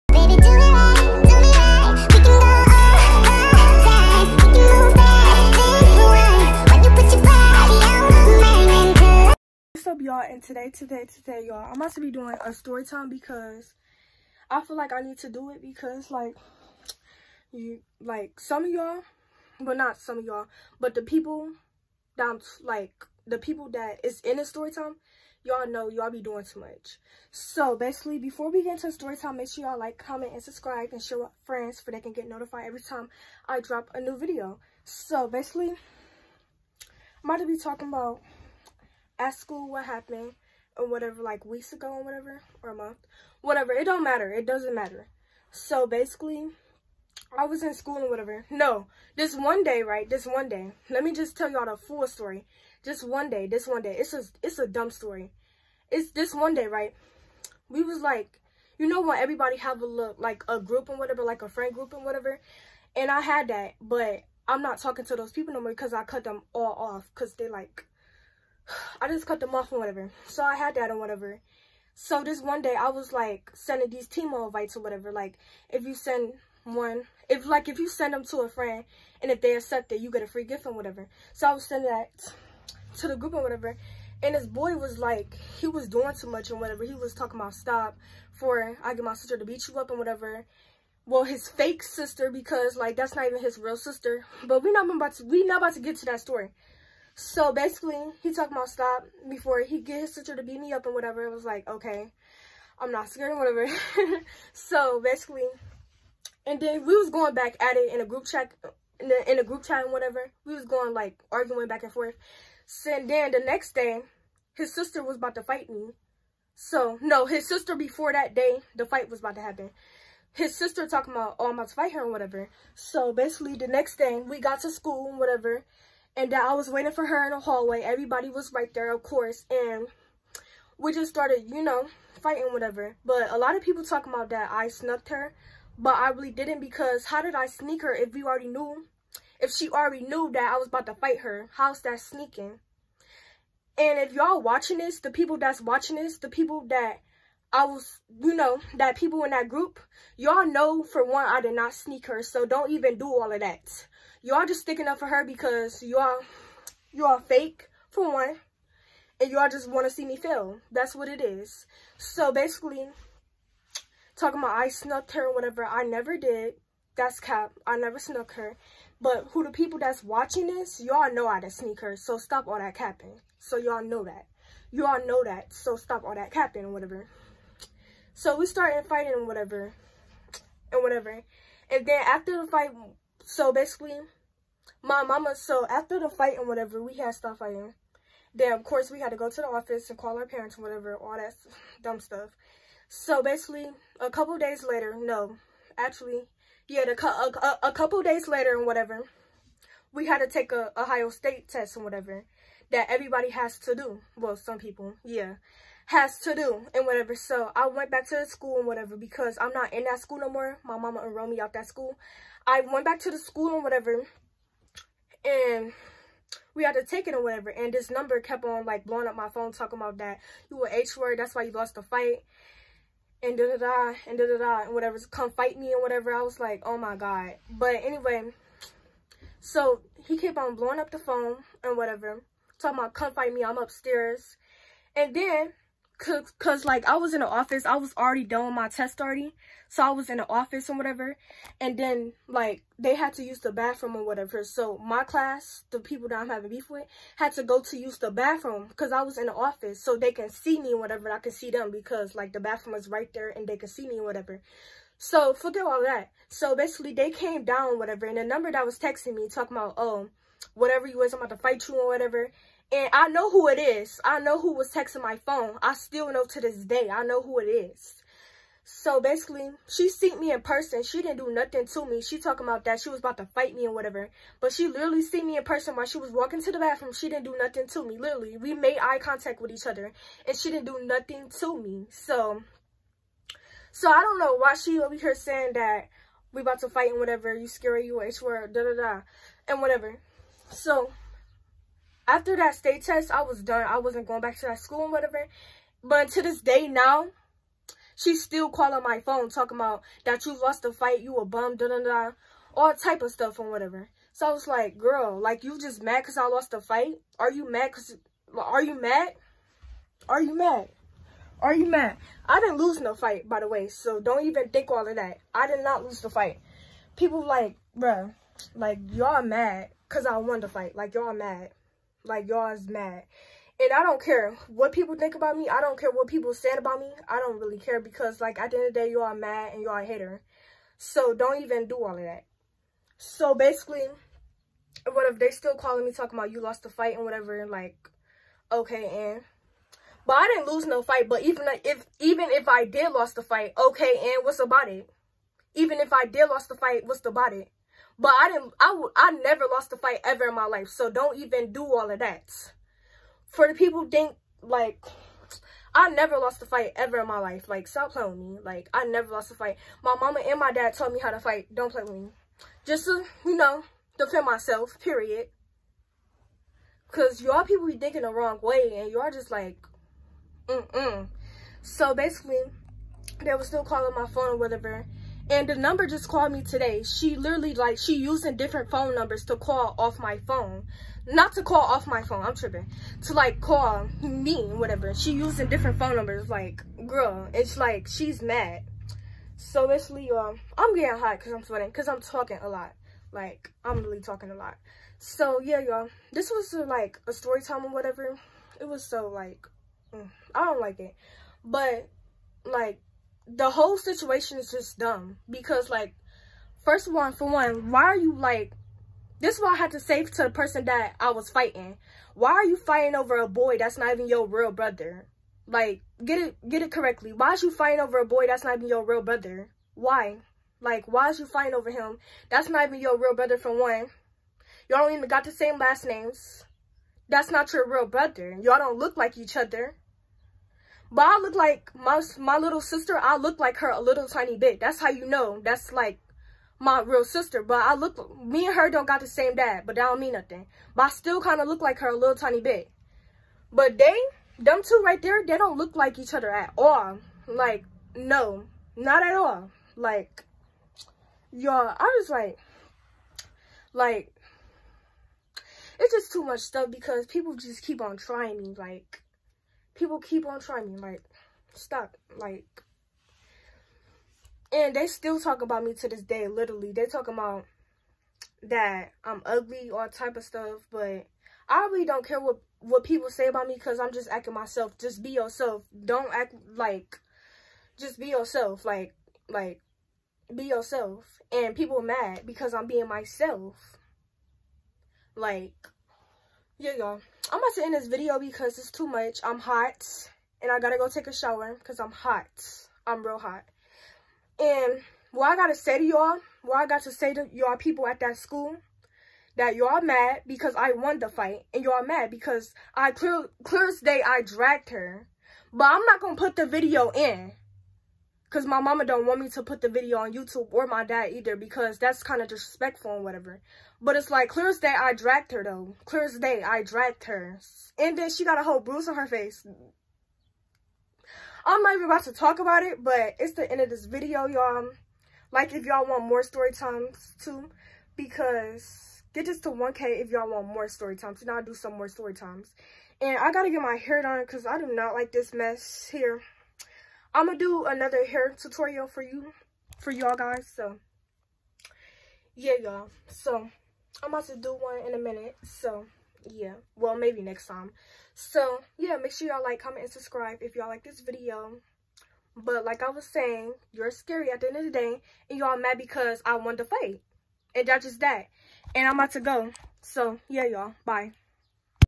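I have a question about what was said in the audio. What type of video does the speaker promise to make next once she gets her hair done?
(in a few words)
hair tutorial.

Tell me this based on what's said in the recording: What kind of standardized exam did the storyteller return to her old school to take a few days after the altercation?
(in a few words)
Ohio State test.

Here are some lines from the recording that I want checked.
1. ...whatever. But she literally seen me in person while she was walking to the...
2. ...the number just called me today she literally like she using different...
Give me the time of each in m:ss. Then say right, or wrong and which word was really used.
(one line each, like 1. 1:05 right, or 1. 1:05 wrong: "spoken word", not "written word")
1. 4:33 right
2. 6:15 right.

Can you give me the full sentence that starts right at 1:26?
He was talking about stop for I get my sister to beat you up and whatever.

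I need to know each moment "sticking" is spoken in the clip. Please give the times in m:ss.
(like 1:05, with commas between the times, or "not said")
2:34.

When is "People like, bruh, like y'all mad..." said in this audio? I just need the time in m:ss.
5:16.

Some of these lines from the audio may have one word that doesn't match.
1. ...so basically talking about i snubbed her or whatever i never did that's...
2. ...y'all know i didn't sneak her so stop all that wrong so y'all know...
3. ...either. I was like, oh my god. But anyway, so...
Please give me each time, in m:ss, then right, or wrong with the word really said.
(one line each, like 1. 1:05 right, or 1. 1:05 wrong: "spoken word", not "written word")
1. 2:41 right
2. 2:50 wrong: "capping", not "wrong"
3. 3:45 wrong: "whatever", not "either".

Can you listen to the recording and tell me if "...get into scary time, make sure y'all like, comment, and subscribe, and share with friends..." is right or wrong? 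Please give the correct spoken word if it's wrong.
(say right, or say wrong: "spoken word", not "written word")
wrong: "story", not "scary".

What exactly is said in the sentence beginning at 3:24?
Well, some people, yeah has to do and whatever.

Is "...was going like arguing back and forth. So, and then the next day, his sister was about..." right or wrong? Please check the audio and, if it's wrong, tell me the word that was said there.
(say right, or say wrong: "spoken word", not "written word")
right.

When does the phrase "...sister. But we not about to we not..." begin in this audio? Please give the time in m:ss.
1:33.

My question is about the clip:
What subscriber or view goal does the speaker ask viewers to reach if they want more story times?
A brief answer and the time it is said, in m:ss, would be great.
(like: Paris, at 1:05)
1K, at 8:49.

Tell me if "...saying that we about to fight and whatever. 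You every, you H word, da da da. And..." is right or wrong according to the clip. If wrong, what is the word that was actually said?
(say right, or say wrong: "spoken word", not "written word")
wrong: "scary", not "every".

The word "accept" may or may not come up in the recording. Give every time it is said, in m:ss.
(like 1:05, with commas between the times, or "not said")
1:19.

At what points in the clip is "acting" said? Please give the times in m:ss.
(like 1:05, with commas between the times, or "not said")
7:54.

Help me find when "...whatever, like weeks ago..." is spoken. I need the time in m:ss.
0:40.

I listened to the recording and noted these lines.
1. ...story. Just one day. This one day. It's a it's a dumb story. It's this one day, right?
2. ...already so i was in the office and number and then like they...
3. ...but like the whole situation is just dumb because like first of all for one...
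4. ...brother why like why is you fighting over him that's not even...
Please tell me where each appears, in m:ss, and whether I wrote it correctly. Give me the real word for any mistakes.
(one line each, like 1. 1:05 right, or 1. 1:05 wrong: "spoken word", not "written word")
1. 0:52 right
2. 3:59 wrong: "whatever", not "number"
3. 6:41 right
4. 6:59 right.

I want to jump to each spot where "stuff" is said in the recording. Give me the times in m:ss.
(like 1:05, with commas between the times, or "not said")
3:11, 5:03, 7:36, 7:50.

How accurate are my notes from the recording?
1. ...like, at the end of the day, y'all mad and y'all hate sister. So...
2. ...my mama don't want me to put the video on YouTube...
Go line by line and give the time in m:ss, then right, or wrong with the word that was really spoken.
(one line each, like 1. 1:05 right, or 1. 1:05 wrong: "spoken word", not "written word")
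1. 5:28 wrong: "hater", not "sister"
2. 8:28 right.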